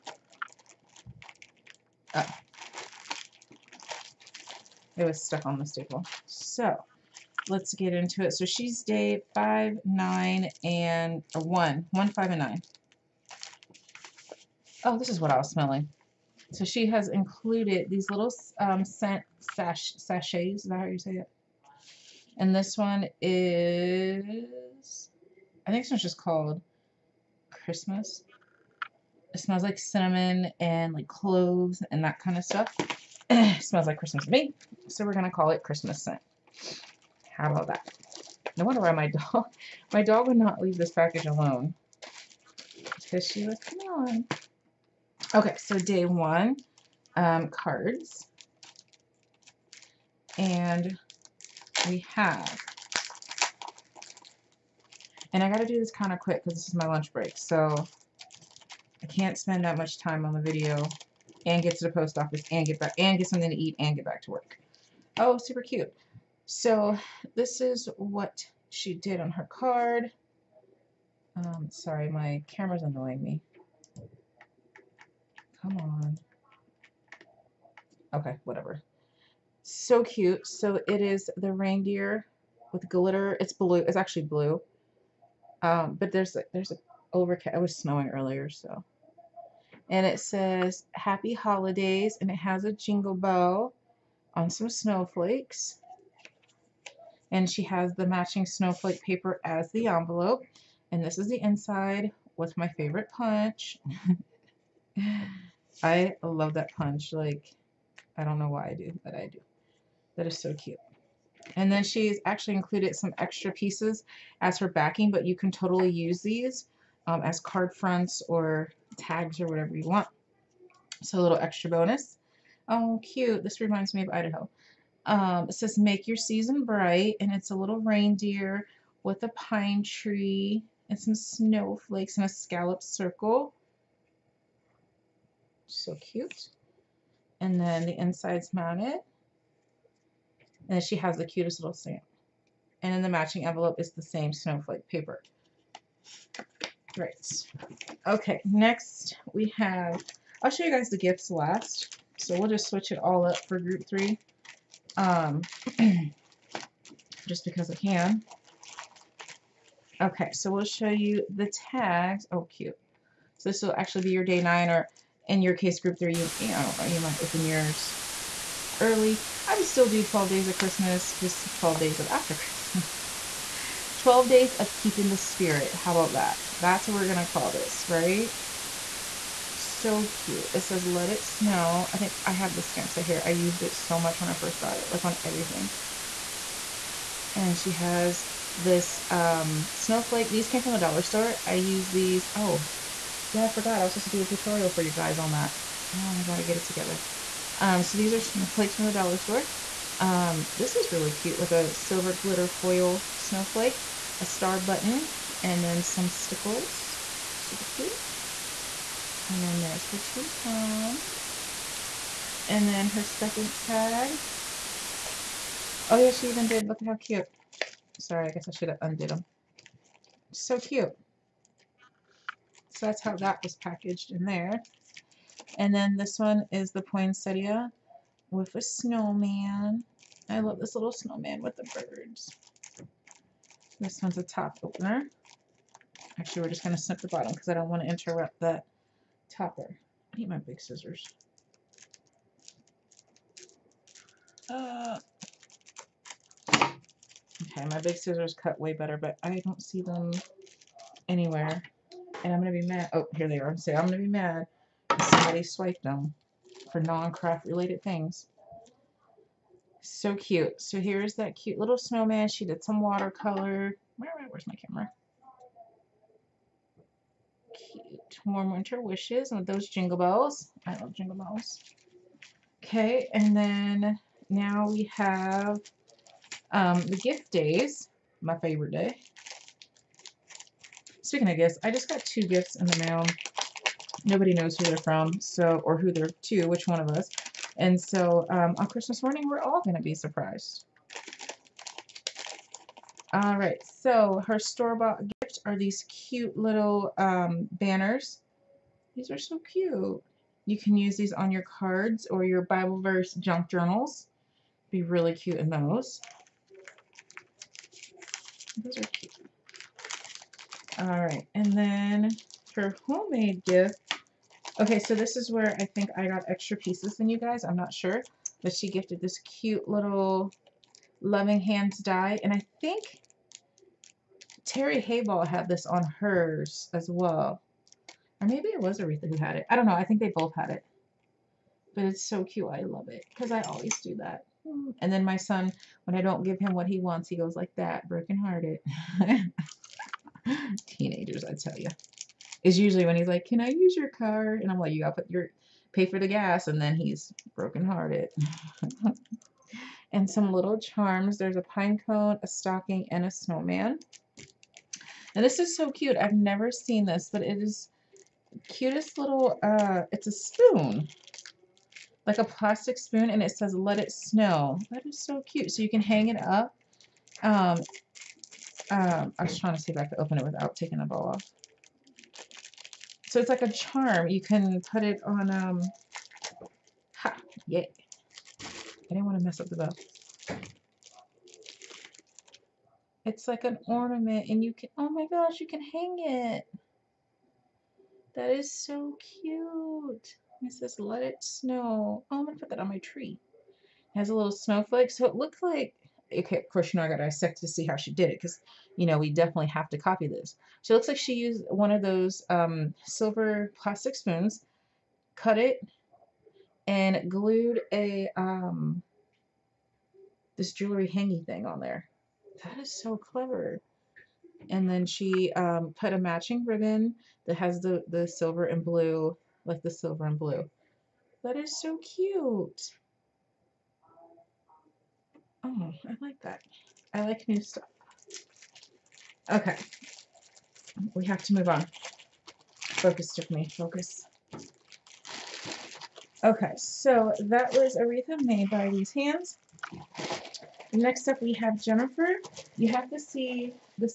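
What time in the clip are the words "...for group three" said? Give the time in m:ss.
2:33.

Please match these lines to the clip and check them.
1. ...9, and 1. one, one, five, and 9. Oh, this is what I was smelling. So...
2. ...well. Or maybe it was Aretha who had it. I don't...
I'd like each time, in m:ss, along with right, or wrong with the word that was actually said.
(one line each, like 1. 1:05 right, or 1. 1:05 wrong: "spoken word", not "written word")
1. 0:09 right
2. 5:26 right.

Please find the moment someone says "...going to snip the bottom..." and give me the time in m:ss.
3:56.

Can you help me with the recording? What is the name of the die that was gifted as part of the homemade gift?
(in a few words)
Loving Hands.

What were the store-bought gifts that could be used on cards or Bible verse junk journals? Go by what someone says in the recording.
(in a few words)
Banners.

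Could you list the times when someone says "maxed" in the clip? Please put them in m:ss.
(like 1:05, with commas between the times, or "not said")
not said.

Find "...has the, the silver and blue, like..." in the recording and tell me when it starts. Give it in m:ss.
6:57.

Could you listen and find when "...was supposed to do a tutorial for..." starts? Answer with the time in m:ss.
3:13.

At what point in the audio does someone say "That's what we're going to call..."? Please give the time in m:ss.
2:56.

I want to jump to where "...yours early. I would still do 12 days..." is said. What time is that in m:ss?
2:47.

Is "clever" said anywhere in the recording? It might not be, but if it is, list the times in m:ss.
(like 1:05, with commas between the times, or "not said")
6:52.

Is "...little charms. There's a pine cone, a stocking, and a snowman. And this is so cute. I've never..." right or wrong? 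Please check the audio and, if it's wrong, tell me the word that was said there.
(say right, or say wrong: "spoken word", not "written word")
right.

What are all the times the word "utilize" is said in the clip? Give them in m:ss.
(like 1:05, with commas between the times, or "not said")
not said.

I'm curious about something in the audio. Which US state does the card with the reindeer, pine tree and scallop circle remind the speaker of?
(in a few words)
Idaho.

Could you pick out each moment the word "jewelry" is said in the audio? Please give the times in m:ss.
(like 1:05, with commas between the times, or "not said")
6:50.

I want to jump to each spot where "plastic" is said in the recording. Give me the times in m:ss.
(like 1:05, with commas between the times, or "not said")
6:02, 6:43.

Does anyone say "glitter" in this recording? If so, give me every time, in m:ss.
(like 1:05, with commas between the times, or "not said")
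1:22, 3:22.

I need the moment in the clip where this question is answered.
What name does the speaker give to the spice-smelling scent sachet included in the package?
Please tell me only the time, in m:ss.
0:35.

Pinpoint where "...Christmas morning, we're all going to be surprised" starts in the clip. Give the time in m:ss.
4:48.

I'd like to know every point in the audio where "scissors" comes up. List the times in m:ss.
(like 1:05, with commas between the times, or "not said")
4:00, 4:07.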